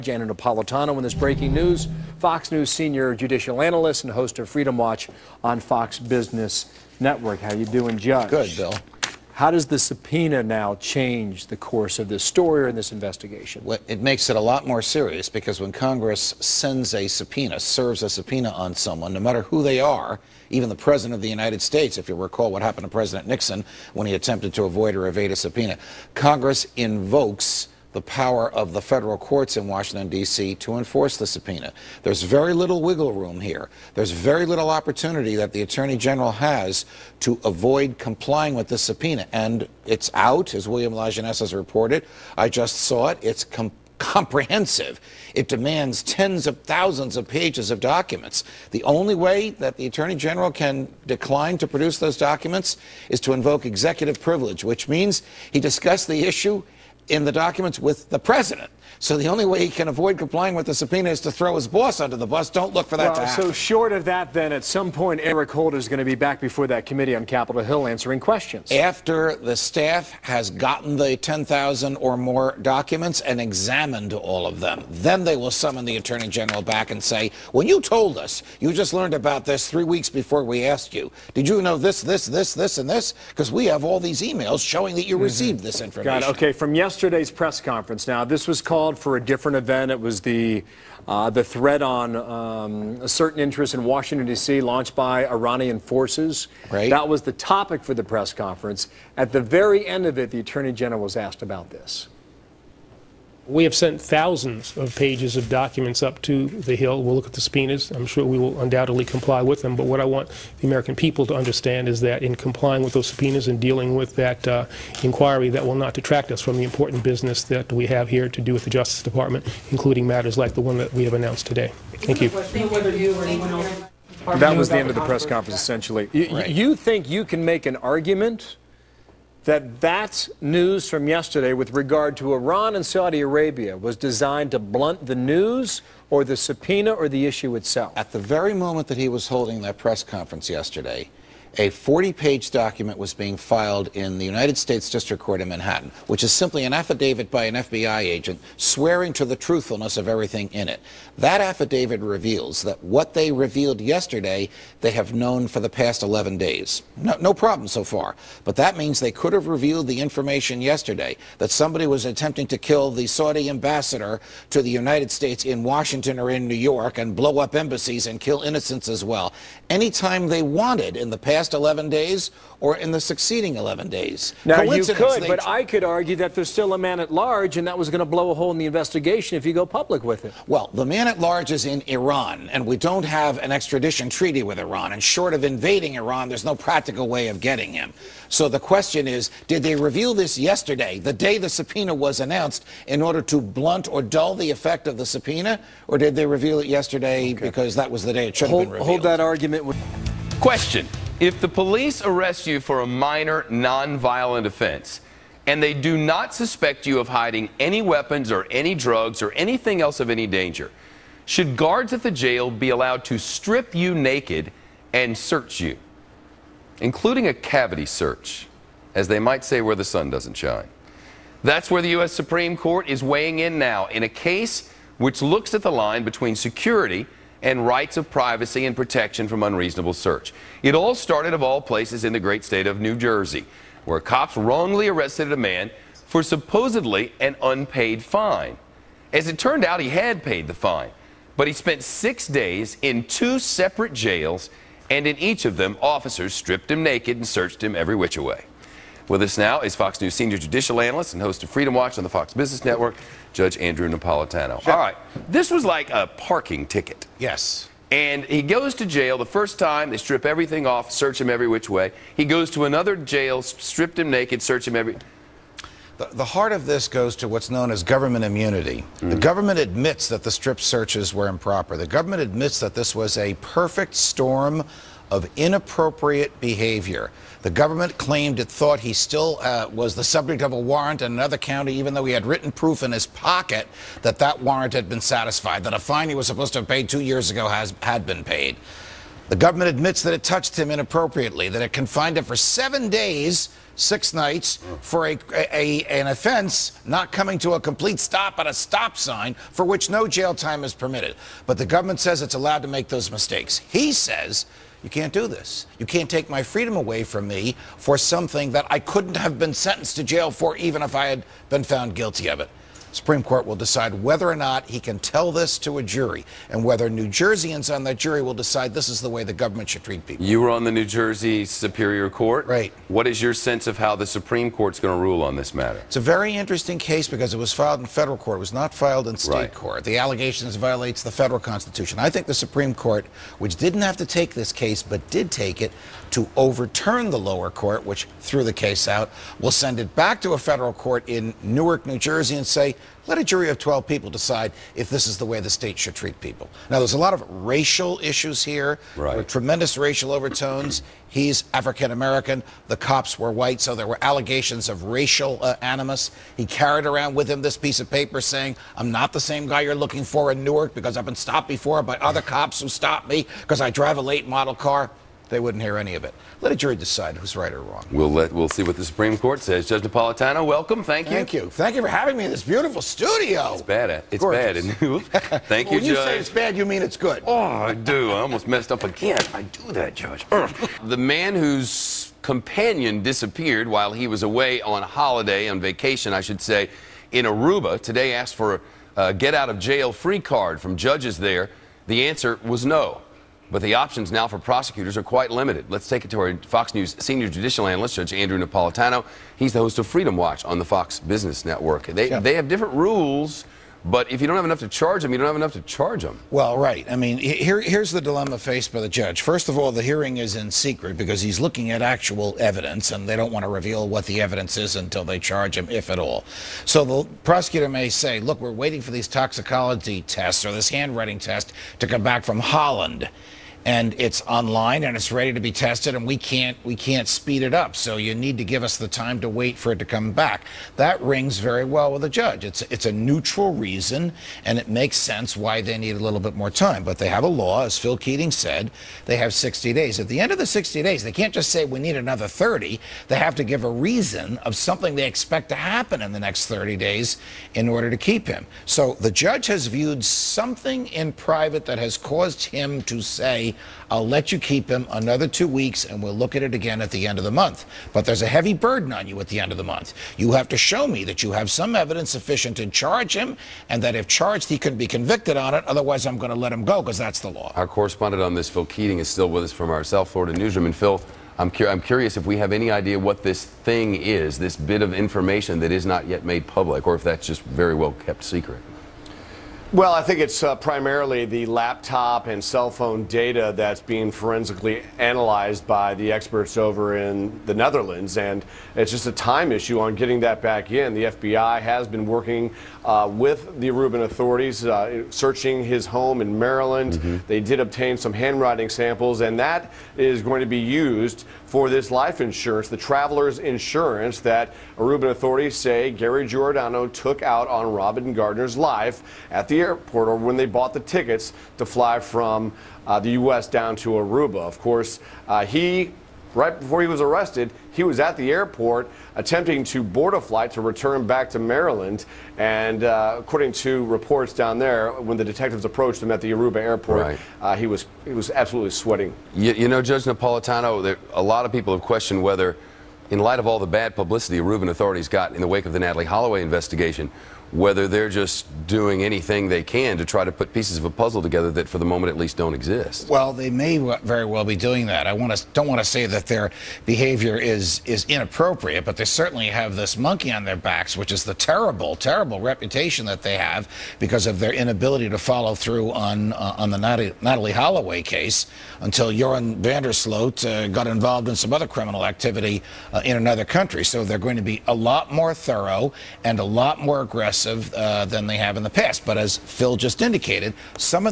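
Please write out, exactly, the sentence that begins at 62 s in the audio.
Don't look for that well, to happen.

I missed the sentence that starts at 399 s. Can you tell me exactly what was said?
He's the host of Freedom Watch on the Fox Business Network.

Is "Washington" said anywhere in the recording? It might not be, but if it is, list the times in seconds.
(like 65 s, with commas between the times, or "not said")
29 s, 93 s, 165 s.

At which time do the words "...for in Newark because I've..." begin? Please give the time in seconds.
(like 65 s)
360 s.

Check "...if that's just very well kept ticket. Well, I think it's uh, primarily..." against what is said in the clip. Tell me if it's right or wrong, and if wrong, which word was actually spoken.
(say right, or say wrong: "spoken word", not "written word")
wrong: "secret", not "ticket".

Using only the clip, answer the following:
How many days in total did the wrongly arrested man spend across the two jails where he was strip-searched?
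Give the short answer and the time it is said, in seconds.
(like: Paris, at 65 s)
6, at 241 s.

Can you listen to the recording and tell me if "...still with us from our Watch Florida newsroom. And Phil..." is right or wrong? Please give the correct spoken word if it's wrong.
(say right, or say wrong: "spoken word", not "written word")
wrong: "South", not "Watch".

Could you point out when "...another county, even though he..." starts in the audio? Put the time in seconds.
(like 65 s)
281 s.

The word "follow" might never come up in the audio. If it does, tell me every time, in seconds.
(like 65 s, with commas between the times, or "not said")
555 s.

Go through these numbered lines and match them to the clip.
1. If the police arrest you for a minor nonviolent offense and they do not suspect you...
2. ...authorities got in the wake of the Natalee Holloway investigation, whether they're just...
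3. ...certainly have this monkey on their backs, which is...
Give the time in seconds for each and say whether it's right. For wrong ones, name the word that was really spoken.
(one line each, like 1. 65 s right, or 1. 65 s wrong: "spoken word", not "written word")
1. 201 s right
2. 534 s right
3. 549 s right.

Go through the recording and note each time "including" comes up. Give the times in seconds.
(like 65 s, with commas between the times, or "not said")
119 s, 216 s.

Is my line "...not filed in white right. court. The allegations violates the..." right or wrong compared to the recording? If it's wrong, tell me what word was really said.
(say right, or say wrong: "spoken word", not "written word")
wrong: "state", not "white".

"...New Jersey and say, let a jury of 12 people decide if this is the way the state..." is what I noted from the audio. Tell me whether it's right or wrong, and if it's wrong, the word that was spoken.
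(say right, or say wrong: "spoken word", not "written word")
right.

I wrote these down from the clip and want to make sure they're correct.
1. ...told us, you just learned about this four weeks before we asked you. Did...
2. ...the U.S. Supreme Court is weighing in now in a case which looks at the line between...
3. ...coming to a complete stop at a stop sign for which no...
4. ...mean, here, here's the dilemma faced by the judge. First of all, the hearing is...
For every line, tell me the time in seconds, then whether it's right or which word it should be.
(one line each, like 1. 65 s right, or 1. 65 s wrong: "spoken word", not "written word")
1. 77 s wrong: "three", not "four"
2. 221 s right
3. 297 s right
4. 406 s right.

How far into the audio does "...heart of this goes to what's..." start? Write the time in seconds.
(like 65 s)
266 s.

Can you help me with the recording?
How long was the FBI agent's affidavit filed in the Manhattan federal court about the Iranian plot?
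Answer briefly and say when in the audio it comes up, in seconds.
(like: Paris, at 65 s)
40 pages, at 141 s.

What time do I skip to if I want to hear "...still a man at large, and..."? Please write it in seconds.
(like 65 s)
176 s.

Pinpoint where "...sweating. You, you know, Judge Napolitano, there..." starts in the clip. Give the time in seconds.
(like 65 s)
528 s.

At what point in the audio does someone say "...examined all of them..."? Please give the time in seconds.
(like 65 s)
73 s.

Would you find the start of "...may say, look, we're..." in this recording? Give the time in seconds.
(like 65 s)
417 s.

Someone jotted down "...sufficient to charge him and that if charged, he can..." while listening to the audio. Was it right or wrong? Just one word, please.
right.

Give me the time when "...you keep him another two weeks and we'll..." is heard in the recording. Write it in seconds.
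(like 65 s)
454 s.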